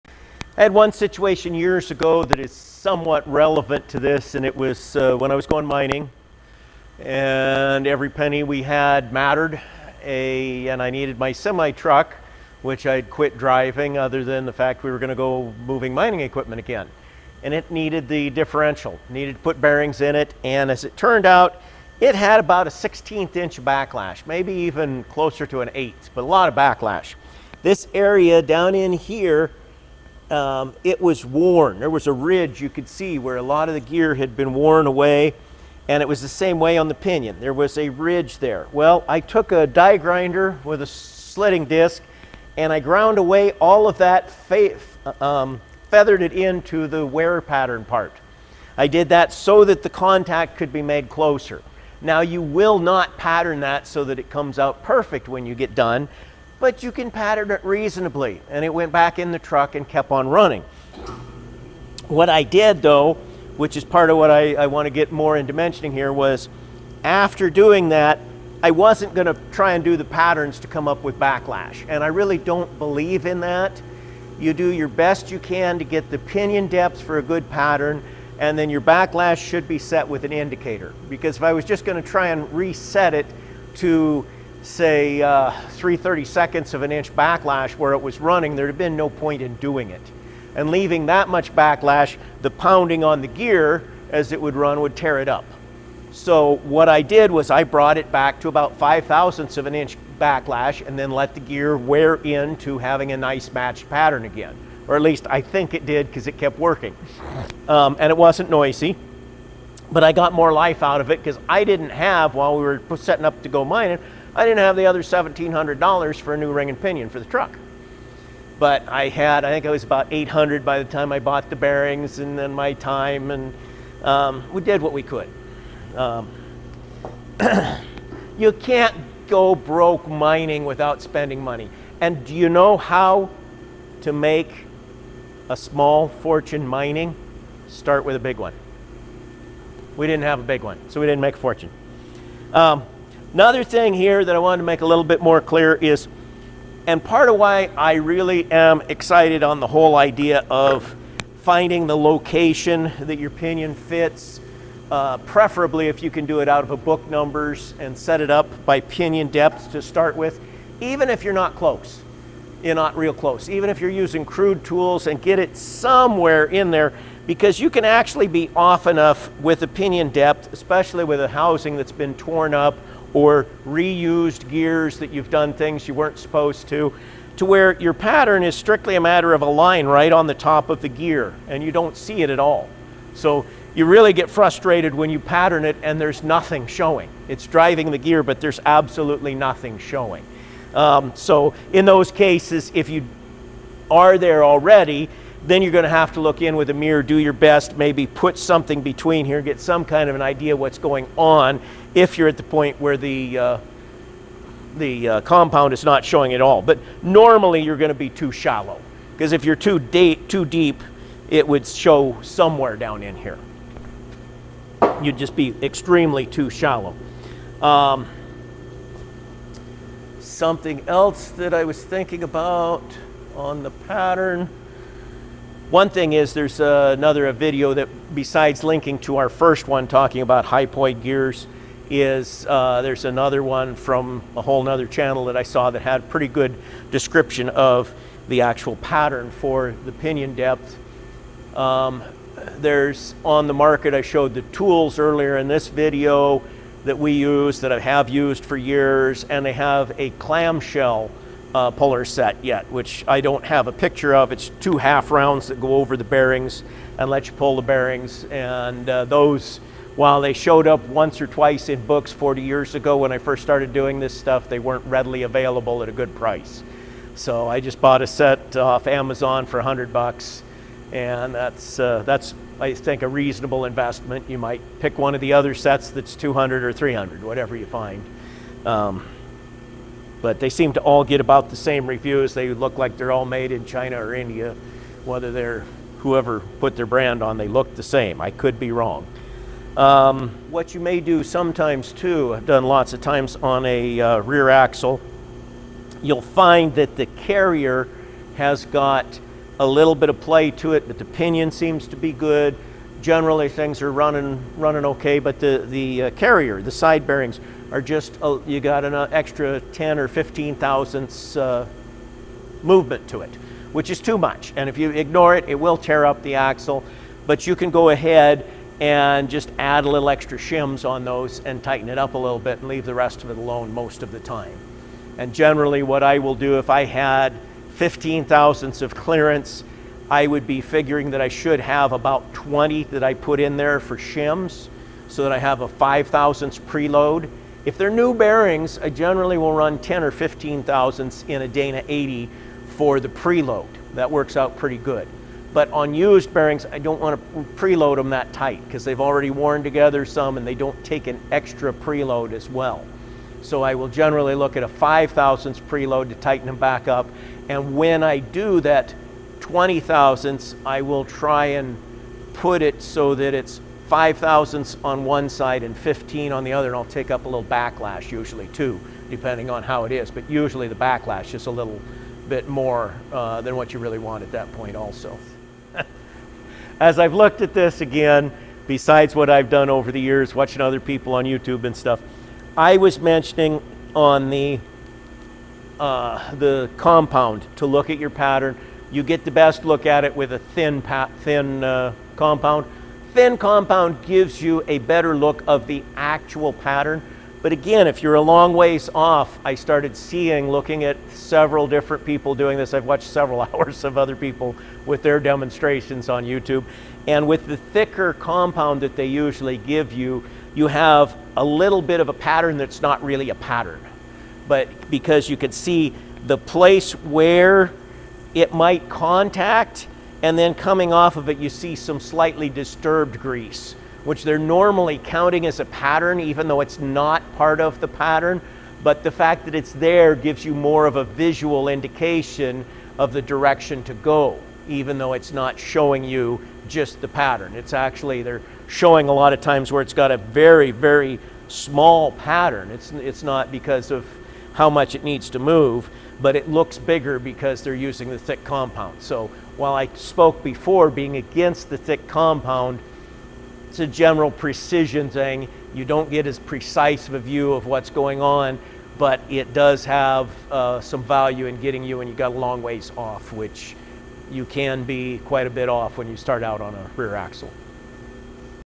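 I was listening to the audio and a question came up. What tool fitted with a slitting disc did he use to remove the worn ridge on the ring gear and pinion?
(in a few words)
Die grinder.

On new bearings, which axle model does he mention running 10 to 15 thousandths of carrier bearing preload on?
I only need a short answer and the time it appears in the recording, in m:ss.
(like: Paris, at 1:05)
Dana 80, at 5:41.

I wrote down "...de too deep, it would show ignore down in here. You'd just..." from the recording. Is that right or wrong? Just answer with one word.
wrong.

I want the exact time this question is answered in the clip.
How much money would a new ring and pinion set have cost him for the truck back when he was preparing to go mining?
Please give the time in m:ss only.
1:55.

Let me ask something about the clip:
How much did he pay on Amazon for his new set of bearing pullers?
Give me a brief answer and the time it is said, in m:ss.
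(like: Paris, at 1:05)
$100, at 4:29.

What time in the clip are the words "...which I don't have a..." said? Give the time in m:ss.
4:12.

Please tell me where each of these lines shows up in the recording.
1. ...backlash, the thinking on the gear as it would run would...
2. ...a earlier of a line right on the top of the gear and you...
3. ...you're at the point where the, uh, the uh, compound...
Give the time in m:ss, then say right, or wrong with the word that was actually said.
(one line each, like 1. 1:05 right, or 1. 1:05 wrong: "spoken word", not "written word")
1. 1:31 wrong: "pounding", not "thinking"
2. 2:58 wrong: "matter", not "earlier"
3. 3:22 right.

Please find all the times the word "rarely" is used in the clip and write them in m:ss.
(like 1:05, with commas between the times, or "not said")
not said.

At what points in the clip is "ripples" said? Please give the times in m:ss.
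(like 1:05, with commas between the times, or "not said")
not said.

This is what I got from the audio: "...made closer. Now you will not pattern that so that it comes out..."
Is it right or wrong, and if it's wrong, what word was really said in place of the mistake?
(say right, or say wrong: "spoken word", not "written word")
right.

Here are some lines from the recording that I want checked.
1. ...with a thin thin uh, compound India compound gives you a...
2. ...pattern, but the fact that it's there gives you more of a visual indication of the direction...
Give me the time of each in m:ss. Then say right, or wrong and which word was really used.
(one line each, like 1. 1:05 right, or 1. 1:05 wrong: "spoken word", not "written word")
1. 6:30 wrong: "Thin", not "India"
2. 7:07 right.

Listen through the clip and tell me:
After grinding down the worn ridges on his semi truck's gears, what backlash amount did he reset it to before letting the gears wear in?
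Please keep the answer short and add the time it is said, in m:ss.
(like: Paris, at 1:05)
5 thousandths of an inch, at 1:38.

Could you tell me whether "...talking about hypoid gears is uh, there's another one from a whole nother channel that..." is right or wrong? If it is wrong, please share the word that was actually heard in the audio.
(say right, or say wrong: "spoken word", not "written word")
right.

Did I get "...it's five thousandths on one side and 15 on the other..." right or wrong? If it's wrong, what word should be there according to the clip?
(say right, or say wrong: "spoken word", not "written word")
right.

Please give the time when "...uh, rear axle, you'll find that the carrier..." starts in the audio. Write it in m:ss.
4:54.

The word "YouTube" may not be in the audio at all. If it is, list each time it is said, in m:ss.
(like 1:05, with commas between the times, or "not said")
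6:21, 6:46.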